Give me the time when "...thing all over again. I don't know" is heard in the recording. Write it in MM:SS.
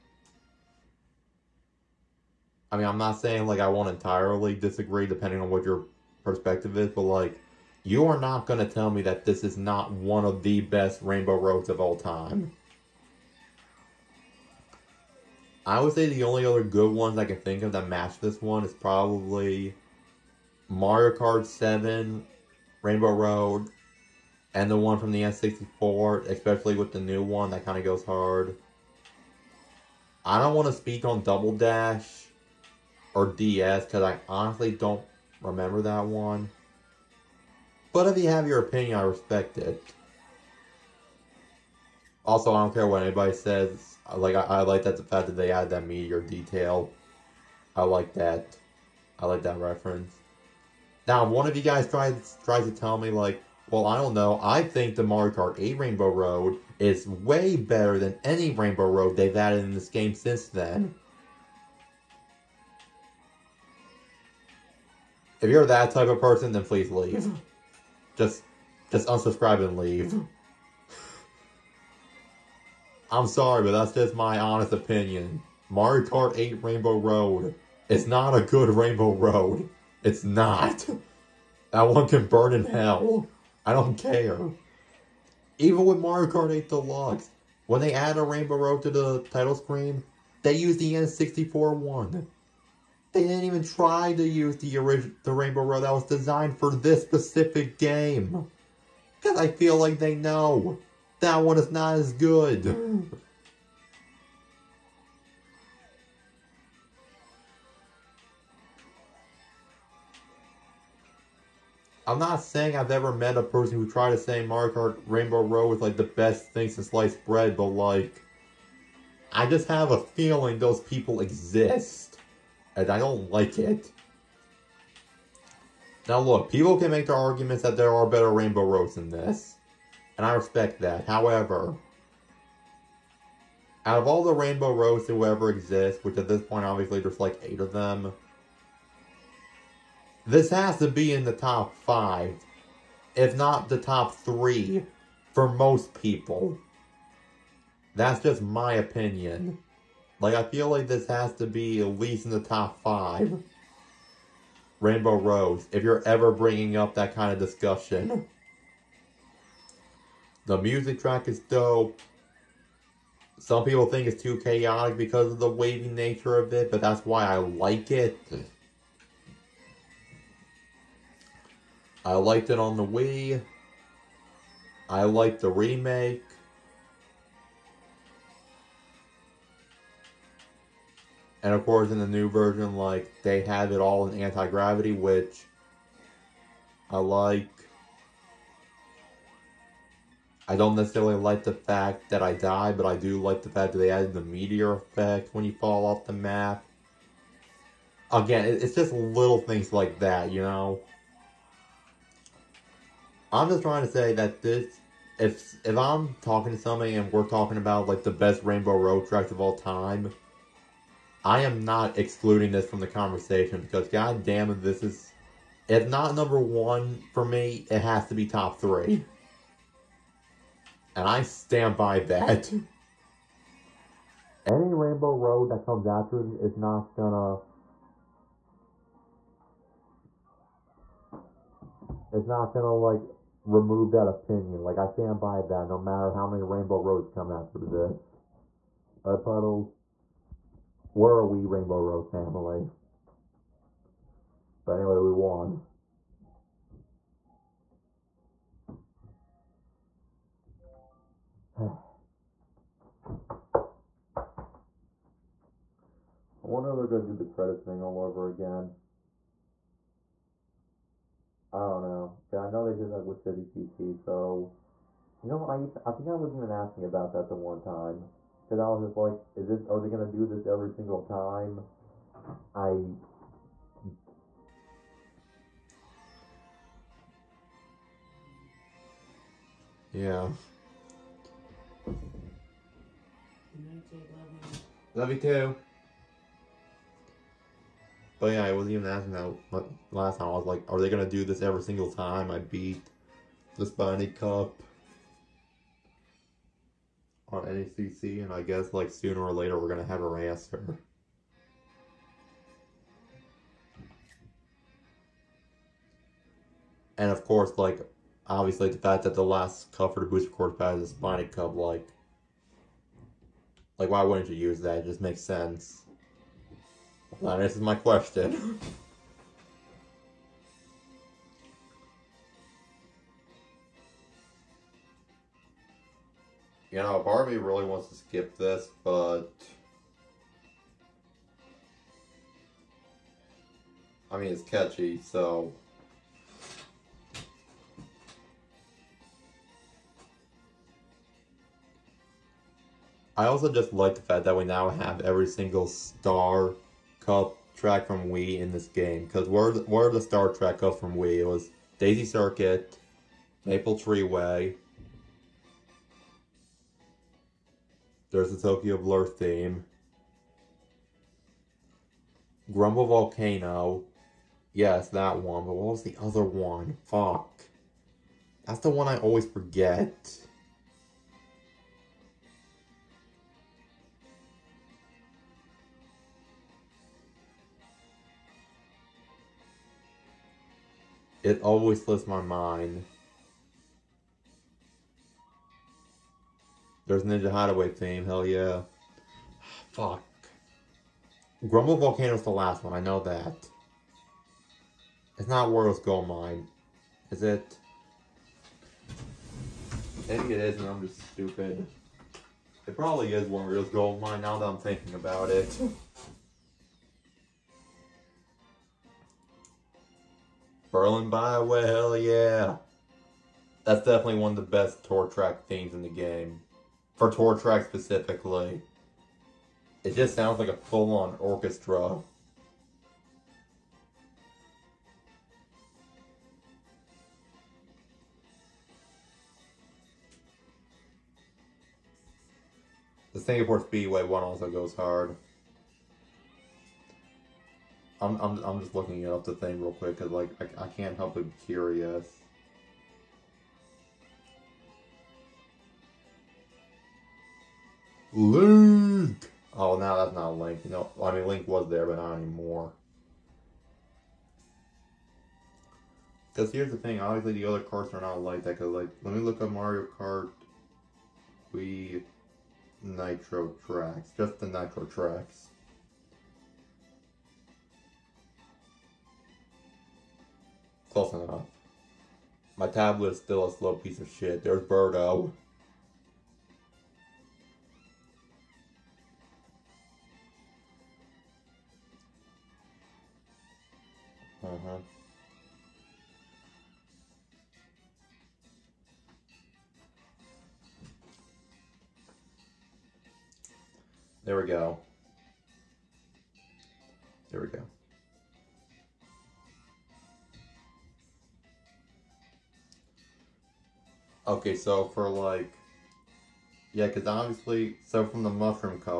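04:17.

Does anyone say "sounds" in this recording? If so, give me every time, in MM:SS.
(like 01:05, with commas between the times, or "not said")
07:00.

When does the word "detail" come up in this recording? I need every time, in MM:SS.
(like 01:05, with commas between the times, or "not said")
00:46.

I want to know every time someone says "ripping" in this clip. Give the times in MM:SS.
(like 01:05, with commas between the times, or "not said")
not said.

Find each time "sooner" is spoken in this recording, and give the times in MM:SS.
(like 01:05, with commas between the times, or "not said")
04:58.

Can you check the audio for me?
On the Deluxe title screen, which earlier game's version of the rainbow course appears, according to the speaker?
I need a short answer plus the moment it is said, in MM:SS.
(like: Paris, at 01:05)
N64, at 01:30.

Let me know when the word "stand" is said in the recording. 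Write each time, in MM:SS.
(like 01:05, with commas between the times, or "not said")
03:41, 03:54.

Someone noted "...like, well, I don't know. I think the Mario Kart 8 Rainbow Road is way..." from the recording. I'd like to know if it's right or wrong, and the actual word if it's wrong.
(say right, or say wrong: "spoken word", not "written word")
right.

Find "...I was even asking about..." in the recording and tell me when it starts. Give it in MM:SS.
04:26.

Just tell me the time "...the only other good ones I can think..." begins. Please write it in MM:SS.
00:16.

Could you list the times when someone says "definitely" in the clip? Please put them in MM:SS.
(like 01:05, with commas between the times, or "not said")
06:53.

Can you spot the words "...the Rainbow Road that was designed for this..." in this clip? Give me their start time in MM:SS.
01:35.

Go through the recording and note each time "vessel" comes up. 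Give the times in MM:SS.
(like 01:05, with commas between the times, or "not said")
not said.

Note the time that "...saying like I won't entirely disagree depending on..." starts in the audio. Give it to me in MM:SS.
00:03.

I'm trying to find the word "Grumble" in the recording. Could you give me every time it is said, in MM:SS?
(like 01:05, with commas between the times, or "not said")
06:02, 06:31.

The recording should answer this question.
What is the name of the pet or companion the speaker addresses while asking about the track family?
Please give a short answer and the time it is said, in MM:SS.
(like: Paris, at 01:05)
Puddles, at 03:59.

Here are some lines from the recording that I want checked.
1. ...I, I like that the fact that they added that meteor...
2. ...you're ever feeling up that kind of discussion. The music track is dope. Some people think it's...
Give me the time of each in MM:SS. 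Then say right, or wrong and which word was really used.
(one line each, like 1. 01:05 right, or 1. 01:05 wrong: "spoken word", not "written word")
1. 00:44 right
2. 02:35 wrong: "bringing", not "feeling".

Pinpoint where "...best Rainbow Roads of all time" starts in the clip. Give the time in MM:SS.
00:10.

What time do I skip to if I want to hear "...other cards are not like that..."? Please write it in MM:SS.
07:37.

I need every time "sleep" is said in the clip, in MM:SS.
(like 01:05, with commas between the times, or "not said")
not said.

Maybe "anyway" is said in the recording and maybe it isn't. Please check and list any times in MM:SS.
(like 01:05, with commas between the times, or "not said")
04:04.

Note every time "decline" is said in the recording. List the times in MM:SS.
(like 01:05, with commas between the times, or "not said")
not said.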